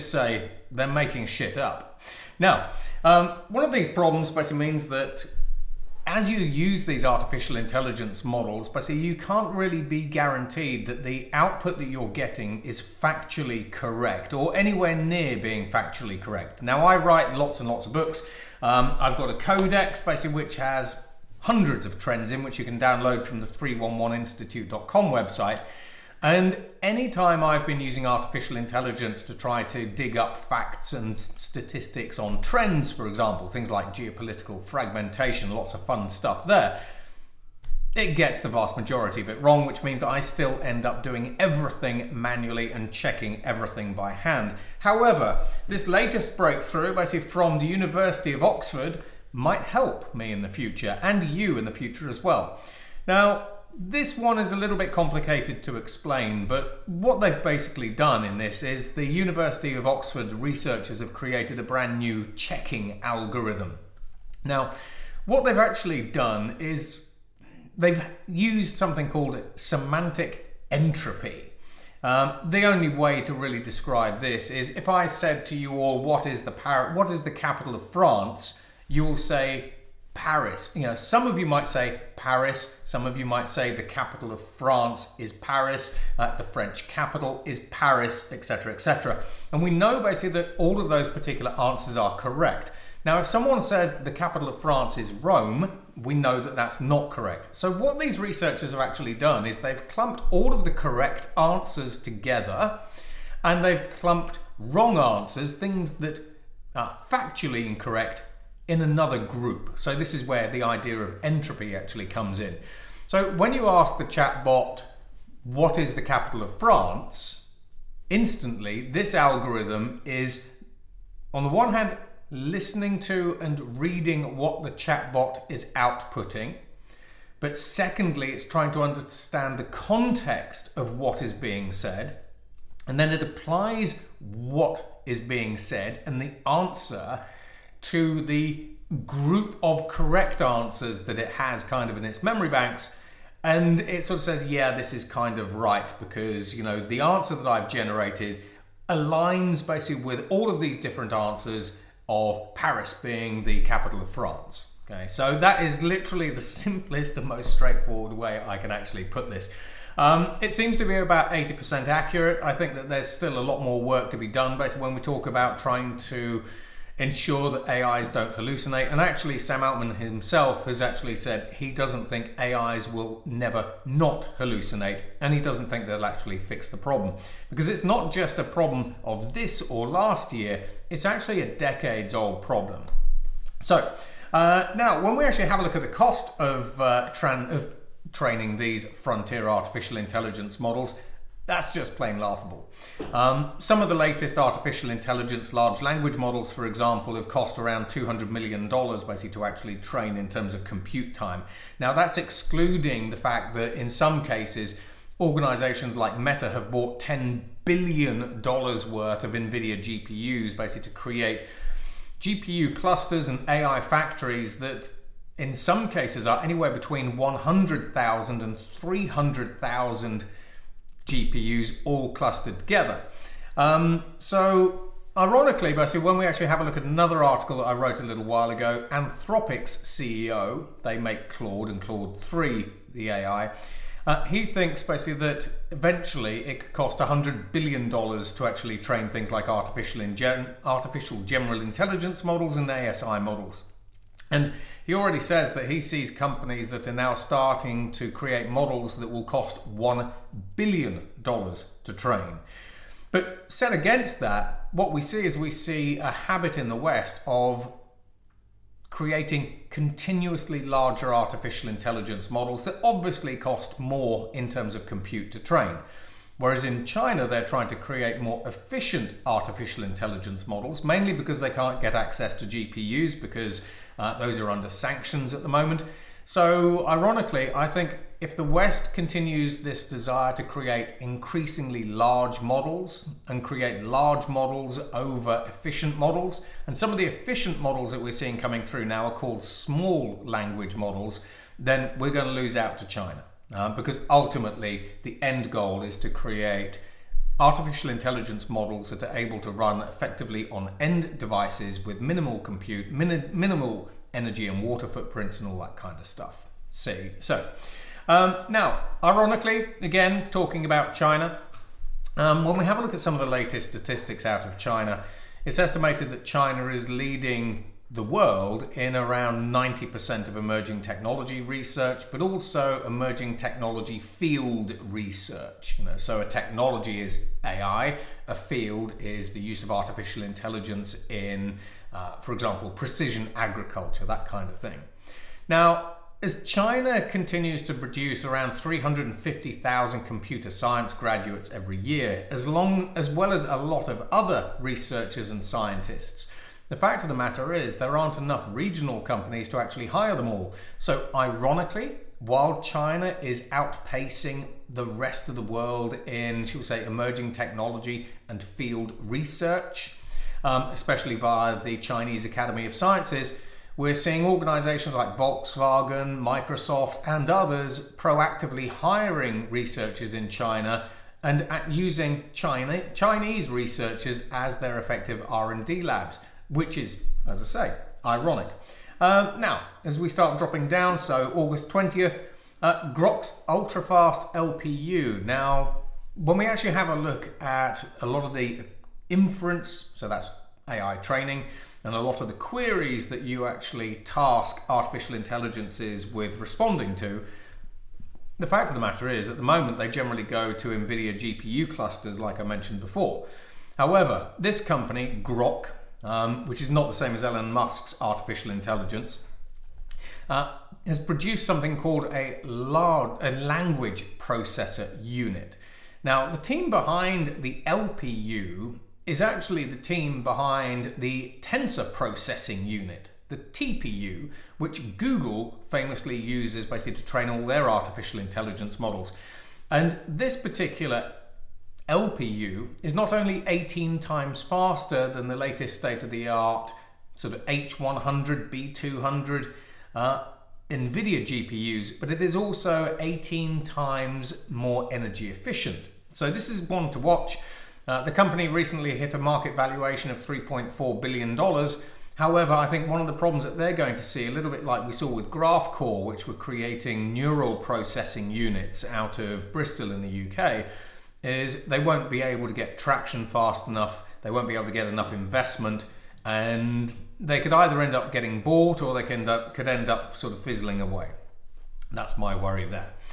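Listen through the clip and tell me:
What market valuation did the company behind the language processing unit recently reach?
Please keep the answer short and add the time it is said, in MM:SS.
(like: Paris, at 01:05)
$3.4 billion, at 07:30.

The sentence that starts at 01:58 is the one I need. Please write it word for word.
Instantly, this algorithm is, on the one hand, listening to and reading what the chatbot is outputting.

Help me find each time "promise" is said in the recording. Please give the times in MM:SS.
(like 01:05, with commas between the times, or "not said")
not said.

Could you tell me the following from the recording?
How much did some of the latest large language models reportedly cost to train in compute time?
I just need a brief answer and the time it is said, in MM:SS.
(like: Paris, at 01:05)
$200 million, at 03:17.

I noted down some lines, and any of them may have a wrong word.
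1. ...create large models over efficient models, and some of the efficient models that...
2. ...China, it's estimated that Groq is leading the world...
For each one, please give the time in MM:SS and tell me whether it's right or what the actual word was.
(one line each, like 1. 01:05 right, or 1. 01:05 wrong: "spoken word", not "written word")
1. 04:43 right
2. 05:14 wrong: "China", not "Groq".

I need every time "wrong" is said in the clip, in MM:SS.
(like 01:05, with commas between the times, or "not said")
00:39, 01:44.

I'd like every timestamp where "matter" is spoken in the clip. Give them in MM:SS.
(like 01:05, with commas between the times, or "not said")
05:47, 06:38.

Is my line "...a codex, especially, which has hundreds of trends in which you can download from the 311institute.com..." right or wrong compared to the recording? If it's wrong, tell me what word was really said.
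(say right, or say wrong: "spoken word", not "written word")
wrong: "basically", not "especially".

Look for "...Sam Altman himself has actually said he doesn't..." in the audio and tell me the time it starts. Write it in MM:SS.
02:49.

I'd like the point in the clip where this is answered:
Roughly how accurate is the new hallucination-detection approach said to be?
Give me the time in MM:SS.
02:41.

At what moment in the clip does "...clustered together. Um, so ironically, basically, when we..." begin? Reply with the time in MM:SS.
03:42.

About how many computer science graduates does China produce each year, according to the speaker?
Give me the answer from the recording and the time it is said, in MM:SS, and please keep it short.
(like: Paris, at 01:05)
350,000, at 05:38.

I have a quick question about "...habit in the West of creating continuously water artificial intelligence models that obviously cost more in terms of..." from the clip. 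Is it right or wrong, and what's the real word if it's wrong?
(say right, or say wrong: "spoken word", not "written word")
wrong: "larger", not "water".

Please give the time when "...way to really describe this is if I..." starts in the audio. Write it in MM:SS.
01:12.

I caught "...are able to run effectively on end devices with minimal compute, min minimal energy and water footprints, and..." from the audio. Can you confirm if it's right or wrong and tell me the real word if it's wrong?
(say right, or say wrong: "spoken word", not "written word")
right.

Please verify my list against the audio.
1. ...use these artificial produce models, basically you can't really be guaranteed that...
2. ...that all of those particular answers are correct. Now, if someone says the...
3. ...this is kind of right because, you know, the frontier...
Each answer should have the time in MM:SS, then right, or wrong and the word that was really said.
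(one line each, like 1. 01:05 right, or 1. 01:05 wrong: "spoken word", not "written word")
1. 00:06 wrong: "intelligence", not "produce"
2. 01:30 right
3. 02:24 wrong: "answer", not "frontier".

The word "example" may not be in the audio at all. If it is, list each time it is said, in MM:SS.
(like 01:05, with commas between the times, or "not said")
00:33, 03:16, 05:32.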